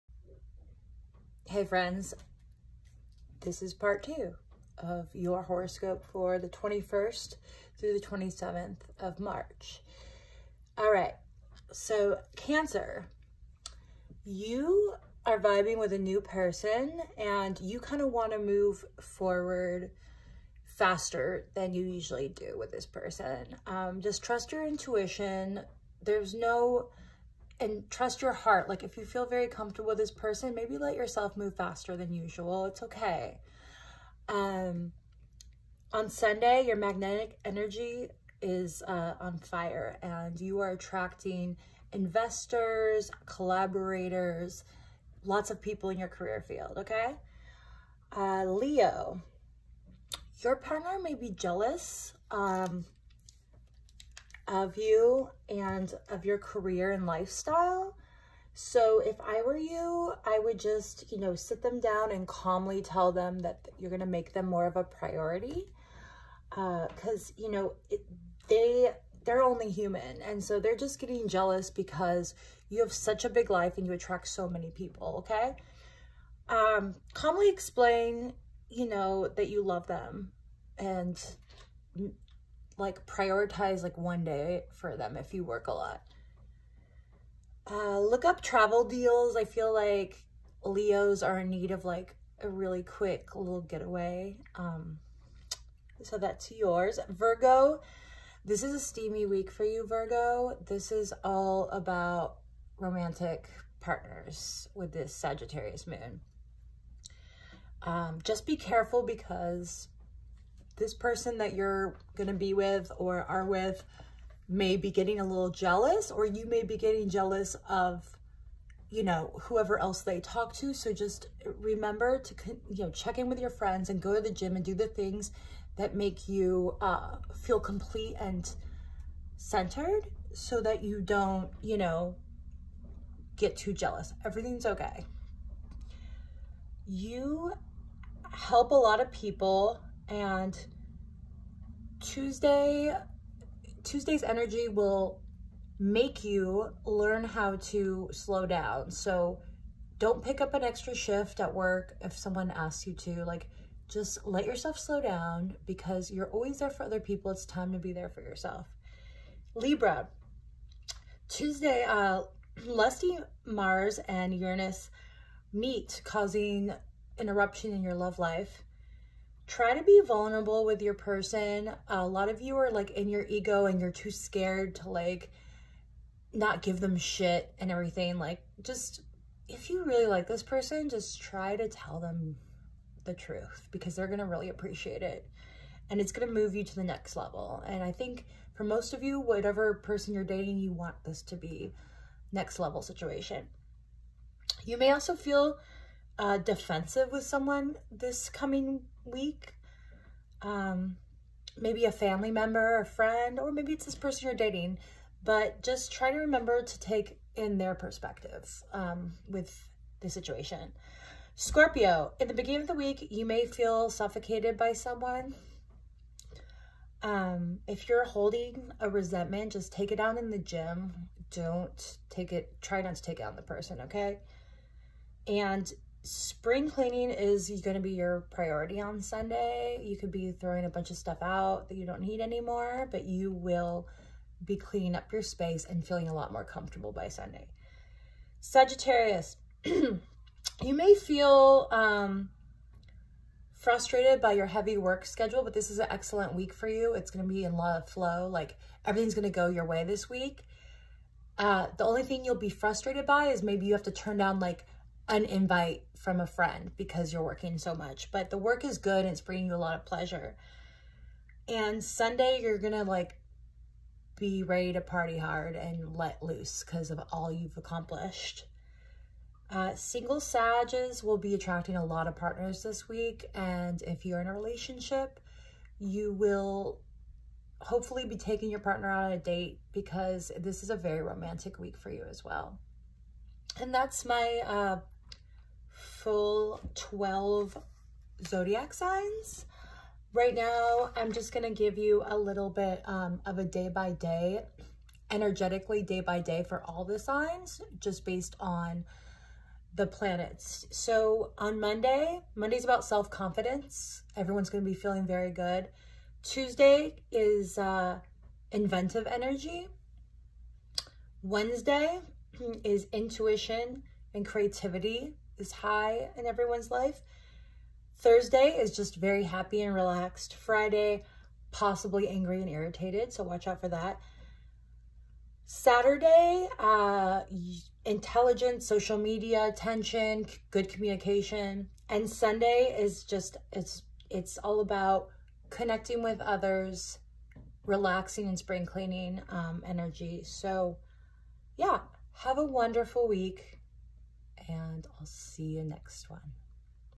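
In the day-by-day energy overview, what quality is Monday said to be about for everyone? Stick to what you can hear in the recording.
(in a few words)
Self-confidence.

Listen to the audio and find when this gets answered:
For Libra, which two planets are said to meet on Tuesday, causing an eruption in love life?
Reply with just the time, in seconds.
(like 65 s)
163 s.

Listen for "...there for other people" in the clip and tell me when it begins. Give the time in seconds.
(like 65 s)
156 s.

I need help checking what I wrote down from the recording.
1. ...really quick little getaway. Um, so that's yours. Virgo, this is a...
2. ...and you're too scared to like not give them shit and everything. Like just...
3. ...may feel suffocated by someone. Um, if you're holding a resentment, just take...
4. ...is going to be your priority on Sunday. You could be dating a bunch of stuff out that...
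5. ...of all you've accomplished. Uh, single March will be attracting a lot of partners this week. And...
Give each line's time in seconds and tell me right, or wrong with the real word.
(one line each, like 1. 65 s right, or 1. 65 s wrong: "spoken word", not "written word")
1. 92 s right
2. 173 s right
3. 213 s right
4. 227 s wrong: "throwing", not "dating"
5. 266 s wrong: "Sages", not "March".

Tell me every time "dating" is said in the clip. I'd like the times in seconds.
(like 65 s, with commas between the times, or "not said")
190 s, 204 s.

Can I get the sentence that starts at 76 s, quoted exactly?
Um, calmly explain, you know, that you love them and like prioritize like one day for them if you work a lot.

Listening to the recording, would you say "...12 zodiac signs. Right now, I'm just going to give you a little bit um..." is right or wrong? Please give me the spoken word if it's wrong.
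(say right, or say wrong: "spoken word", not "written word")
right.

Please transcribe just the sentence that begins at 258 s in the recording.
But the work is good and it's bringing you a lot of pleasure.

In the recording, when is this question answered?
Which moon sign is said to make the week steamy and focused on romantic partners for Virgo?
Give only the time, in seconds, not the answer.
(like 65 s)
105 s.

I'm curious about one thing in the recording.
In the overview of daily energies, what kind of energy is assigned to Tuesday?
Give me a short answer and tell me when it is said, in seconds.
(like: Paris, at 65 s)
Inventive energy, at 308 s.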